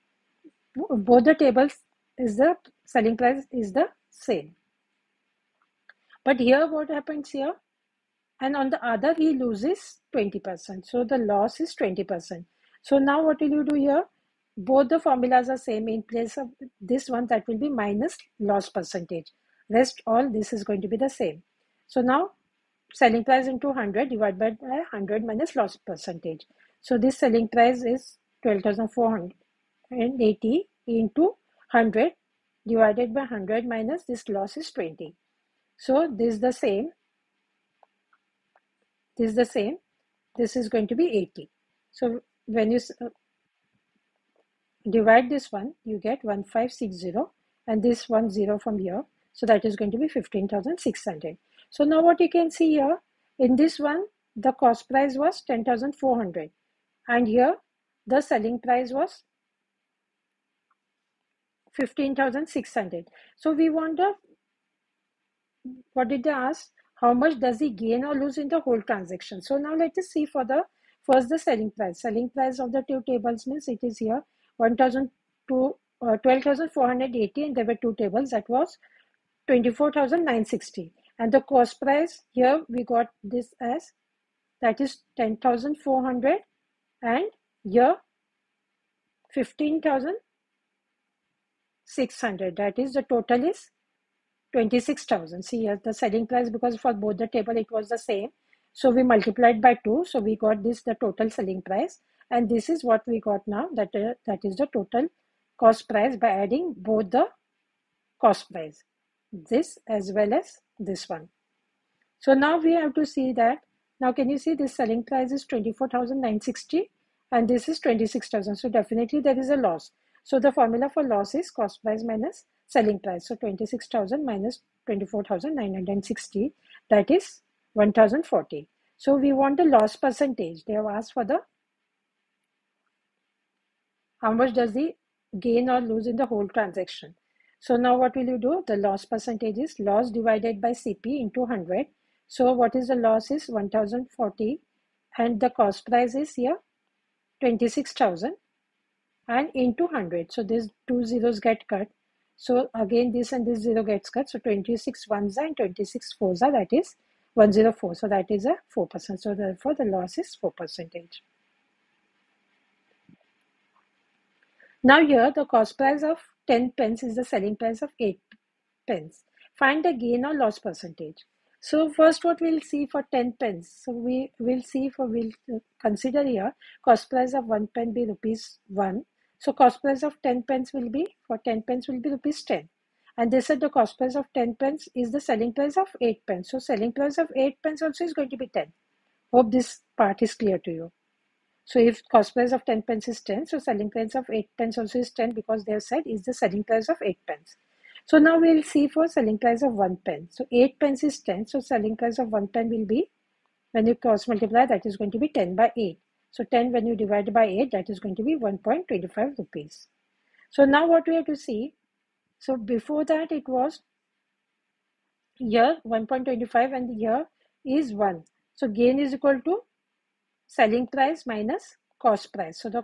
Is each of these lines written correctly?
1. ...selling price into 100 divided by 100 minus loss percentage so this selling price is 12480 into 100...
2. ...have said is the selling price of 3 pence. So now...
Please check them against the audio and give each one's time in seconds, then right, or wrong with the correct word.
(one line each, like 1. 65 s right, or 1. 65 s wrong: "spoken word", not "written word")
1. 22 s right
2. 195 s wrong: "8", not "3".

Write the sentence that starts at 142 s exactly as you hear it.
So what is the loss is 1040 and the cost price is here 26,000 and into 100.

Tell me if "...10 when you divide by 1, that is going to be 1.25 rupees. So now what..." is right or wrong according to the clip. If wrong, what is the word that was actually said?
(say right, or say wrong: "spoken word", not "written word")
wrong: "8", not "1".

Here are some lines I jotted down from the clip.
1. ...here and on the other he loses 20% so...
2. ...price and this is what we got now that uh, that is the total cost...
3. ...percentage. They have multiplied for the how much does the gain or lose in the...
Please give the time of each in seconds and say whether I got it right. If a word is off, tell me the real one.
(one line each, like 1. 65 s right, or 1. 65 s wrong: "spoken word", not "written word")
1. 7 s right
2. 101 s right
3. 129 s wrong: "asked", not "multiplied".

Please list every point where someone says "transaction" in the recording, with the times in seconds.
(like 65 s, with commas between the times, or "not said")
68 s, 136 s.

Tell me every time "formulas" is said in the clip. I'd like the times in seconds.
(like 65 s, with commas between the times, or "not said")
14 s, 120 s.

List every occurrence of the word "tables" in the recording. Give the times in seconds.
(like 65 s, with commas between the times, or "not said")
1 s, 73 s, 77 s, 97 s.